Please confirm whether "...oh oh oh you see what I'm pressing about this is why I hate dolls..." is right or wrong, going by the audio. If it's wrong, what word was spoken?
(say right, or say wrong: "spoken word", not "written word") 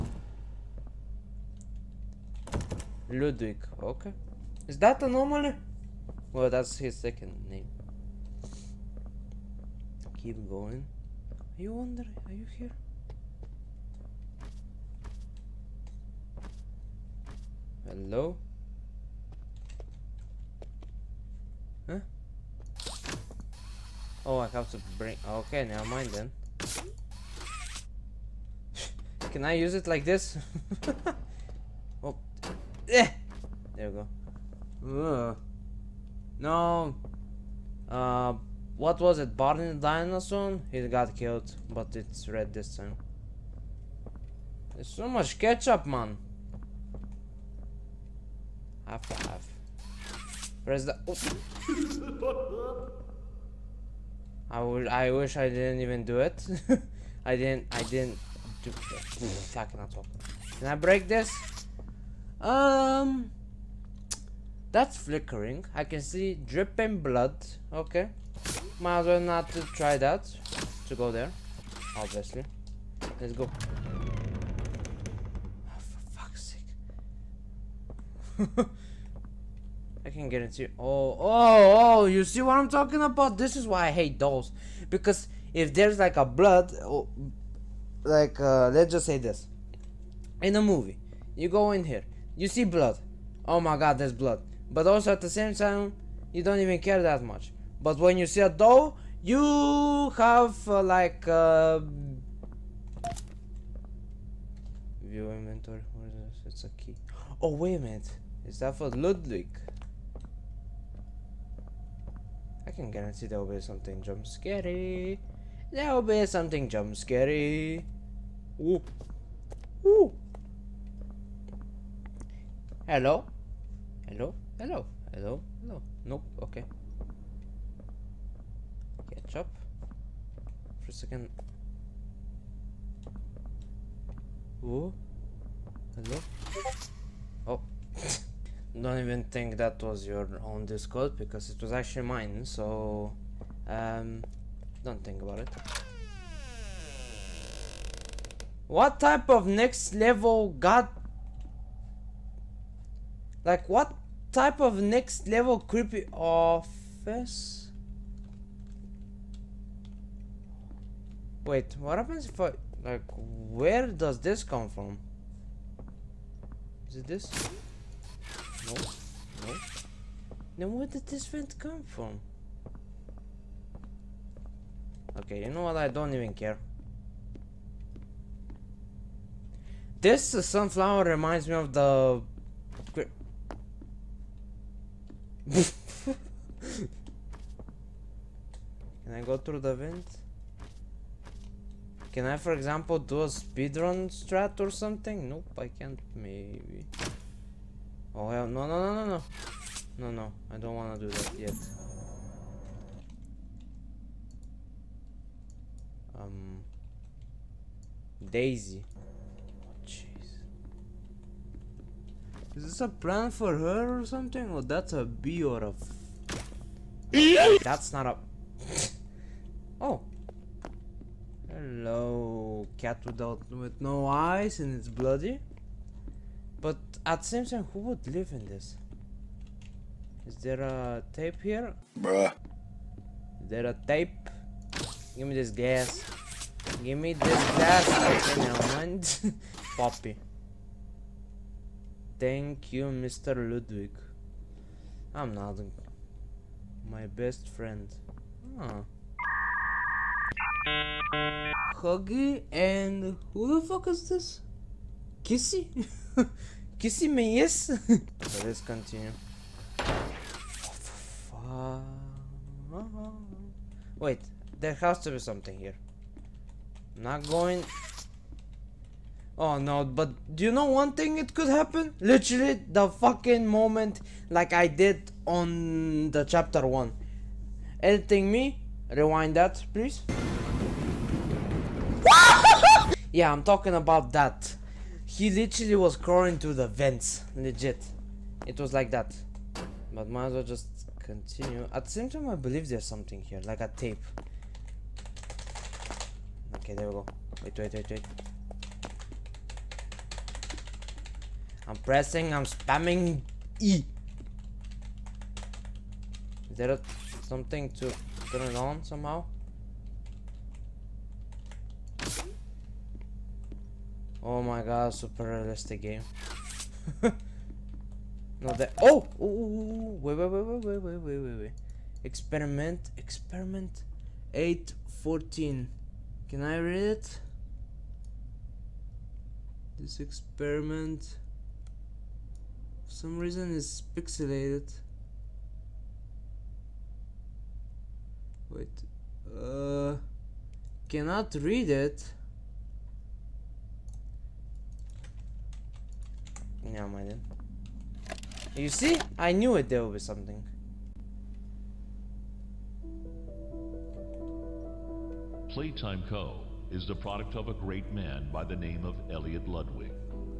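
wrong: "talking", not "pressing".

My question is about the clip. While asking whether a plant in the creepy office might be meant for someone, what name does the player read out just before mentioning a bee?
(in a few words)
Daisy.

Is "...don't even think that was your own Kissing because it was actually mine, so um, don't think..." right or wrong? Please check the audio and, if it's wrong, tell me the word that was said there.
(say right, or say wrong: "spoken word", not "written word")
wrong: "Discord", not "Kissing".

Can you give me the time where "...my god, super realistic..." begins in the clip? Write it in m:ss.
5:14.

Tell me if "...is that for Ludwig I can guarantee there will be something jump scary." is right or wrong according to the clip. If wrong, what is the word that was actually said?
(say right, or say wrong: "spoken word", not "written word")
right.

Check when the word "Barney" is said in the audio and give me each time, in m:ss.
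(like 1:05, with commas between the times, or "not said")
0:39.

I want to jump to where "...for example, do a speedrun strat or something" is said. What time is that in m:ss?
3:12.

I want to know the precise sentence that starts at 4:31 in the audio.
Literally the fucking moment like I did on the chapter 1.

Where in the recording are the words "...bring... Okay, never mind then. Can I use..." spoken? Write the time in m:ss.
0:24.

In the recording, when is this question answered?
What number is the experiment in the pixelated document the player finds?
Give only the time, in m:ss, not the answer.
5:22.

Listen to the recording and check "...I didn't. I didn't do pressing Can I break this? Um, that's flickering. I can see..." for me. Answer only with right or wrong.
wrong.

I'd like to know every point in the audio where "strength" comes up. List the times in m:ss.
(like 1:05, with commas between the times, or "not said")
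not said.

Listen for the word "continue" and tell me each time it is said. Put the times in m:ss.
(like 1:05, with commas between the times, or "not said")
4:18, 4:50.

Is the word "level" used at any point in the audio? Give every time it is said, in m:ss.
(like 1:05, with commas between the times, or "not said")
2:29, 2:35.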